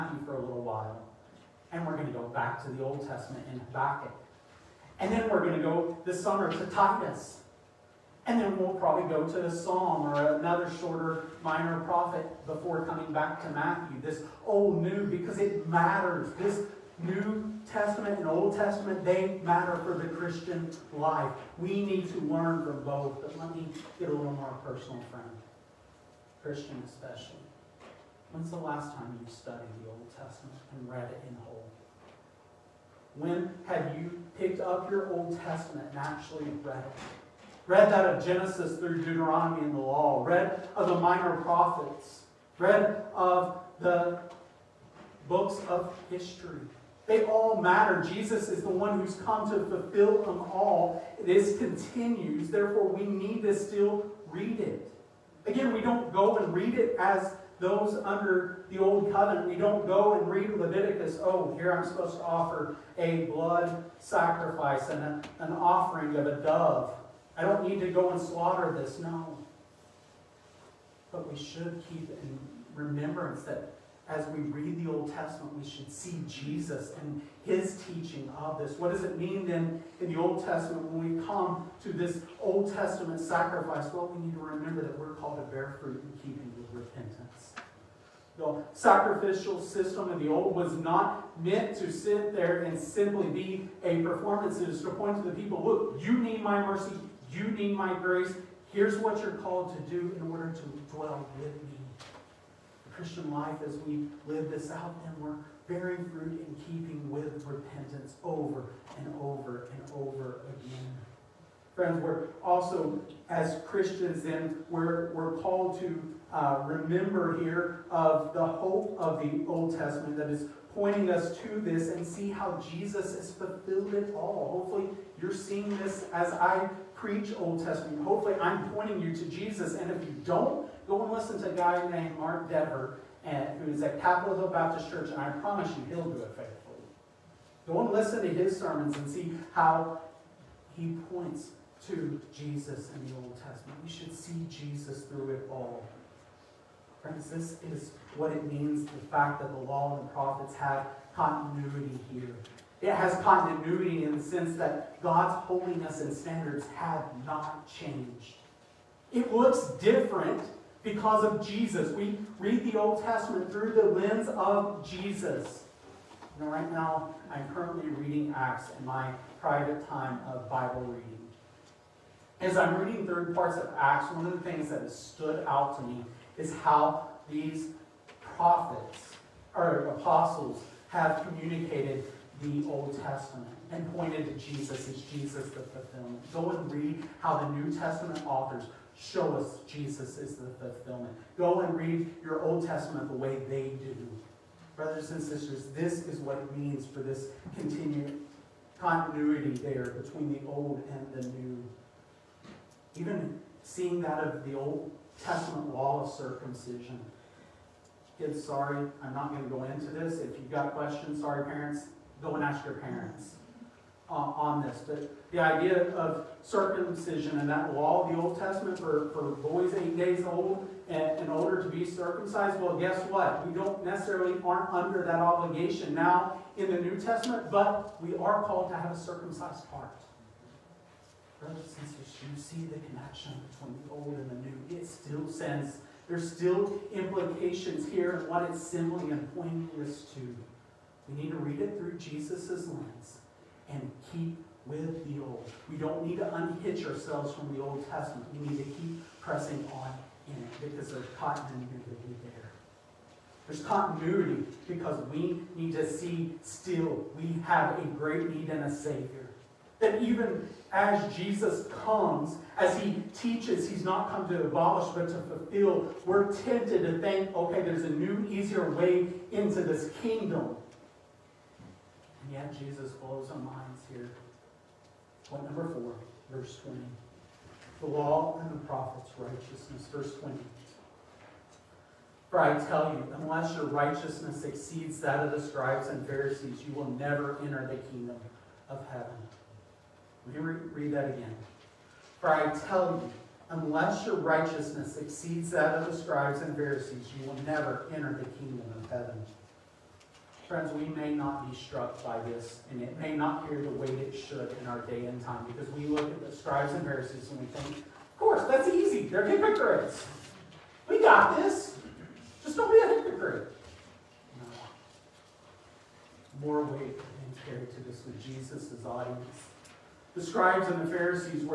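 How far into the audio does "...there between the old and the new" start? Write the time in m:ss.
3:19.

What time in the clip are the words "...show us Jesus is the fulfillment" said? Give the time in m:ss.
3:08.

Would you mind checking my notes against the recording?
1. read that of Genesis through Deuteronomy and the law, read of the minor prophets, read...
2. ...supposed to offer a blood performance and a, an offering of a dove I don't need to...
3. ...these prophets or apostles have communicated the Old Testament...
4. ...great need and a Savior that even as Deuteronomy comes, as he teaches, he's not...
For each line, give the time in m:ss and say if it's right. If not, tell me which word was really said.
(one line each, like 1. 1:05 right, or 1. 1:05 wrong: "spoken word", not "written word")
1. 0:37 right
2. 1:01 wrong: "sacrifice", not "performance"
3. 2:57 right
4. 4:17 wrong: "Jesus", not "Deuteronomy".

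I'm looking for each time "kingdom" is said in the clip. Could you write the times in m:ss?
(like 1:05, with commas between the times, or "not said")
4:30, 4:47, 4:58.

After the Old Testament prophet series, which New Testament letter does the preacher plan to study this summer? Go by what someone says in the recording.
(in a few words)
Titus.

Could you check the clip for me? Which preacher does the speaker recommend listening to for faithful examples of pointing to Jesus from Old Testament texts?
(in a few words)
Mark Dever.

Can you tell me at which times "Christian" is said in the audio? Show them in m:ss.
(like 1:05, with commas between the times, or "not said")
0:20, 0:26, 1:42, 1:53.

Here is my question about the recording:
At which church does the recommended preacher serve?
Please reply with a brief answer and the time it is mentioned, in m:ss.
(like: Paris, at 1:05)
Capitol Hill Baptist Church, at 2:14.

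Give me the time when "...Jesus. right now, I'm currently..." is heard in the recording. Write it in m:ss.
2:44.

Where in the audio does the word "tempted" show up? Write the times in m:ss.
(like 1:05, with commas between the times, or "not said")
4:26.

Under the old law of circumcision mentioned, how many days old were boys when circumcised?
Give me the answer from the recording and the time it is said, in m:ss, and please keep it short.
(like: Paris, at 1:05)
8, at 3:39.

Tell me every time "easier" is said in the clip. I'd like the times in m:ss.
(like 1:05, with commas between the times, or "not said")
4:28.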